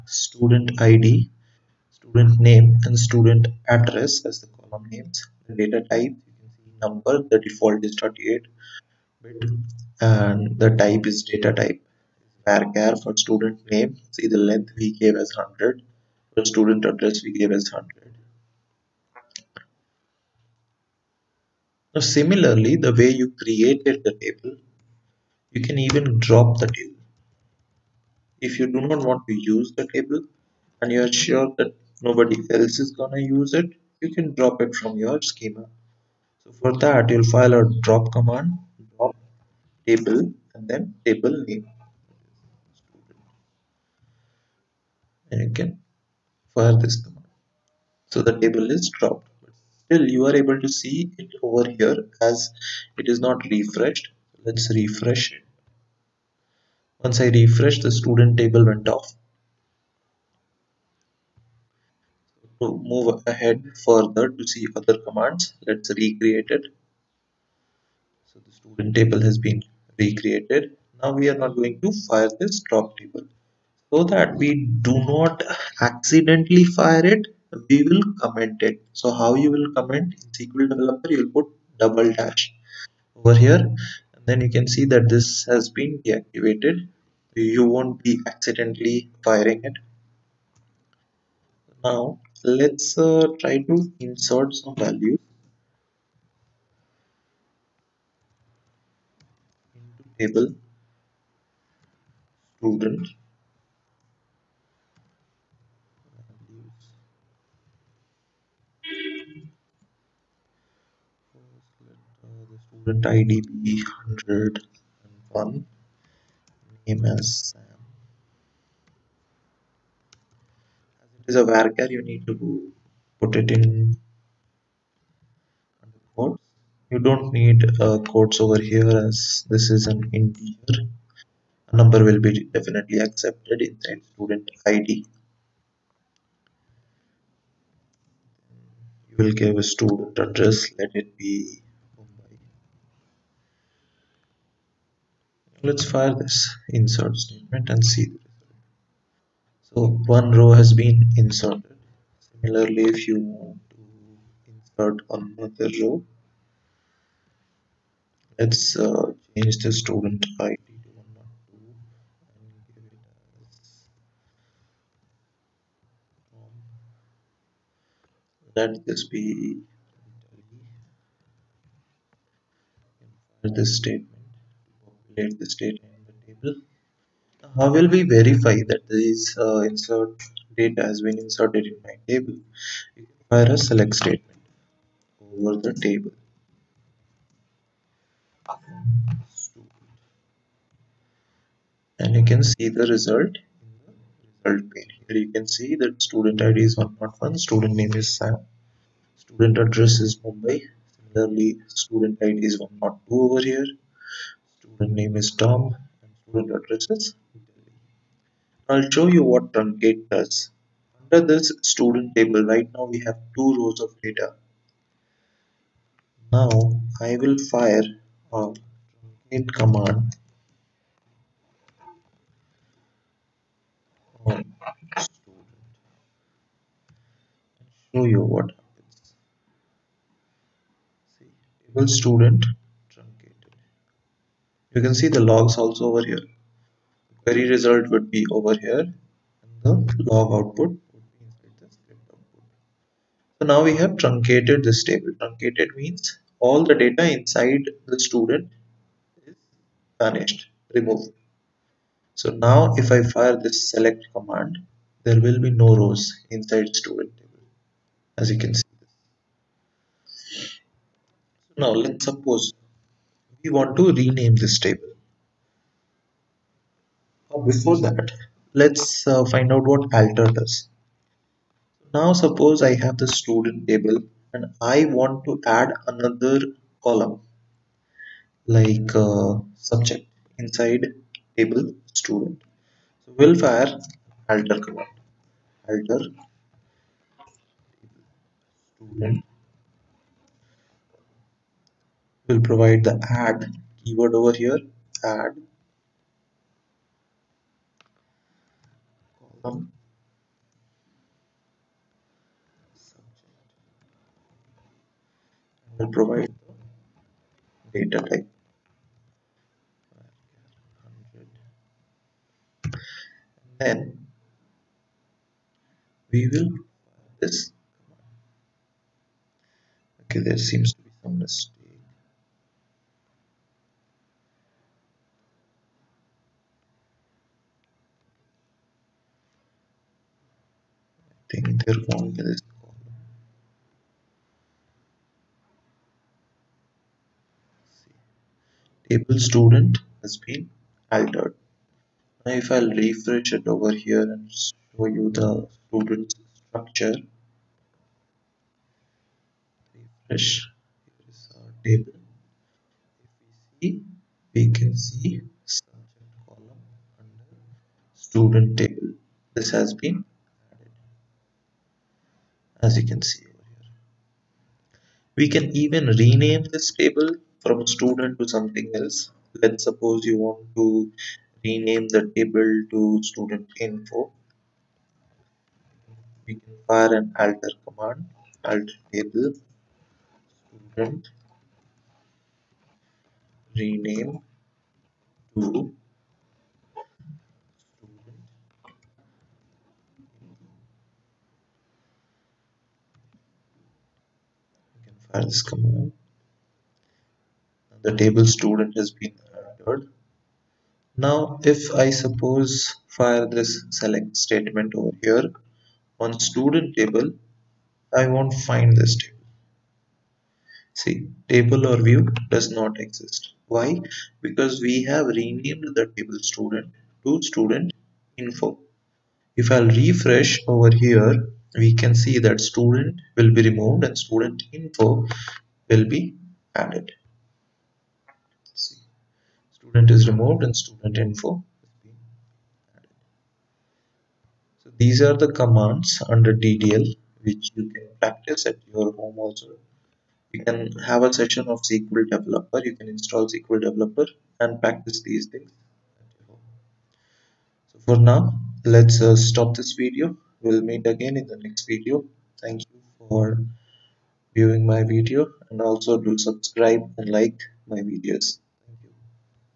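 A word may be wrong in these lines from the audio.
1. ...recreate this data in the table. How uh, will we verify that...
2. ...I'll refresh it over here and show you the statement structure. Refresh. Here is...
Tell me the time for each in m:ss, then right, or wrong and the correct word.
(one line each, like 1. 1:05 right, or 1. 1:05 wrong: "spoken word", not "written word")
1. 2:55 wrong: "update", not "recreate"
2. 5:42 wrong: "student", not "statement".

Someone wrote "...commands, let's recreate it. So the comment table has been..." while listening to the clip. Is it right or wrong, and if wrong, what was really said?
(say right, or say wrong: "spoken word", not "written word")
wrong: "student", not "comment".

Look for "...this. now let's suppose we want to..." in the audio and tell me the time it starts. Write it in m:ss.
4:18.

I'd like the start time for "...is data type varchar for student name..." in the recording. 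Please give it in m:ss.
0:11.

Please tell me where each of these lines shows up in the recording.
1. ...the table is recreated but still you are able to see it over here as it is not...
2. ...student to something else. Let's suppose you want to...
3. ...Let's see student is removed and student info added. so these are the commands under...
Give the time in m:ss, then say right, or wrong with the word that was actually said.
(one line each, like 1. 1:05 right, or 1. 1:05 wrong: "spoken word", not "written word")
1. 0:48 wrong: "dropped", not "recreated"
2. 6:07 right
3. 7:08 right.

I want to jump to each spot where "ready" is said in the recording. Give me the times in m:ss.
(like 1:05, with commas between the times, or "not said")
not said.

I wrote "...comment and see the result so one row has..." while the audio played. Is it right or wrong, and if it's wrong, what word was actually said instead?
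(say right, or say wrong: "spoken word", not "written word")
wrong: "statement", not "comment".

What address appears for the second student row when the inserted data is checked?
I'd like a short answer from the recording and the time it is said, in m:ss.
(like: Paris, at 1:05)
Delhi, at 3:27.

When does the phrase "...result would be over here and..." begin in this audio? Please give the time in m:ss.
3:57.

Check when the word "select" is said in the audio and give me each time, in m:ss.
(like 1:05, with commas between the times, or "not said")
3:03, 4:13, 6:43.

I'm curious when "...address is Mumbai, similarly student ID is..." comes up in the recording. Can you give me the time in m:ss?
3:19.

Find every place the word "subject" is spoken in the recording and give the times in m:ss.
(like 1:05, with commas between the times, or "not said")
4:39, 5:55.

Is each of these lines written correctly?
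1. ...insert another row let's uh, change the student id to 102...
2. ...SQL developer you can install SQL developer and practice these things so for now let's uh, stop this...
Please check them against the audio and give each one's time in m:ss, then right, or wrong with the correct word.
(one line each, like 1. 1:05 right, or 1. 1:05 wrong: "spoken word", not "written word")
1. 2:34 right
2. 7:21 right.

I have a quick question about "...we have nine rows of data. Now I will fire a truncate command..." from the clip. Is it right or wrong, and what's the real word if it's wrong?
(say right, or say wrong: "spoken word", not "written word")
wrong: "two", not "nine".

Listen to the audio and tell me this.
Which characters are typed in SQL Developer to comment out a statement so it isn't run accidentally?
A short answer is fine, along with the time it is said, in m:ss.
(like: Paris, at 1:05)
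double dash, at 1:21.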